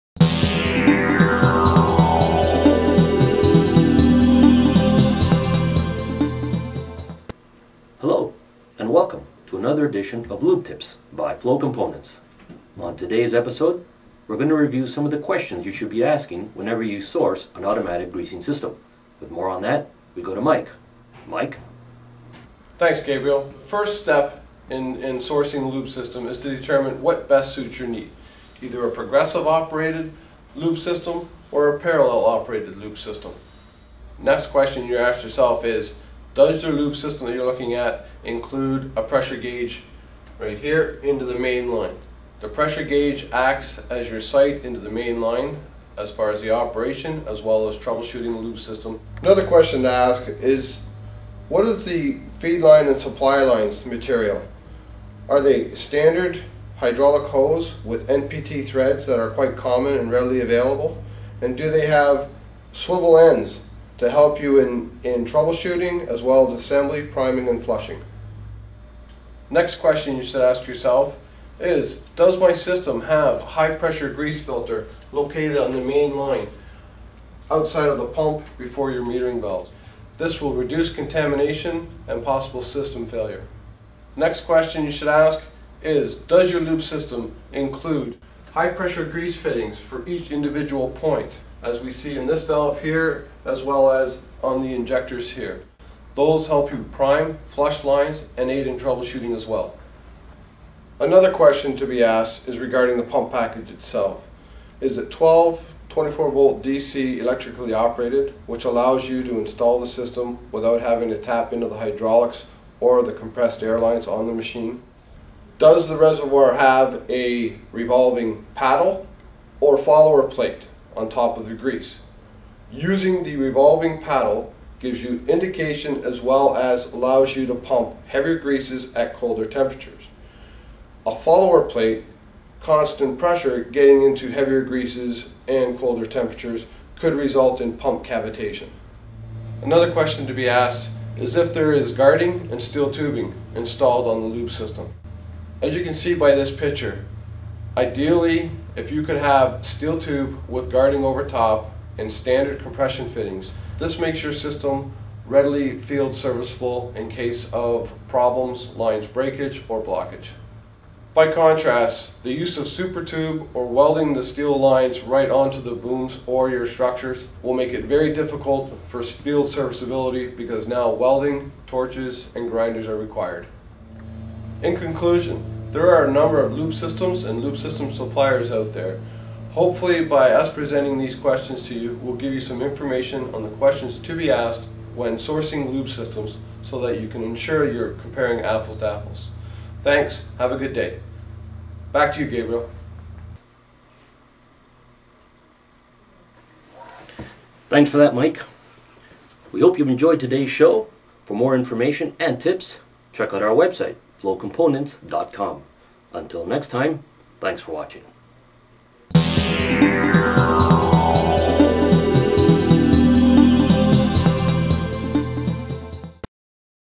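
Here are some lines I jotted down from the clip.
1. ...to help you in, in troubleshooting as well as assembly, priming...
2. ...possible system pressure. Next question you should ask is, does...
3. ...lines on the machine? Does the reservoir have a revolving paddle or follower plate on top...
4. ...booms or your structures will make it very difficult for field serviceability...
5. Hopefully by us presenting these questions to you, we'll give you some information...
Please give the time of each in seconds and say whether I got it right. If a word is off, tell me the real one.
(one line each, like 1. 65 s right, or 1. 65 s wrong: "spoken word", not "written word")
1. 64 s right
2. 82 s wrong: "failure", not "pressure"
3. 113 s right
4. 165 s right
5. 179 s right.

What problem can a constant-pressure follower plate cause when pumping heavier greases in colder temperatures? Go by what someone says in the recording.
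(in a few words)
pump cavitation.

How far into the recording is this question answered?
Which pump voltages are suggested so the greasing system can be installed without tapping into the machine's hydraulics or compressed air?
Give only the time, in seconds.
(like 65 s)
105 s.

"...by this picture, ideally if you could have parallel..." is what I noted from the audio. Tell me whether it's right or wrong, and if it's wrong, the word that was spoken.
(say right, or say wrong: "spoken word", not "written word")
wrong: "steel", not "parallel".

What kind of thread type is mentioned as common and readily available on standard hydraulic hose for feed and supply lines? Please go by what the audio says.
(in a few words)
NPT.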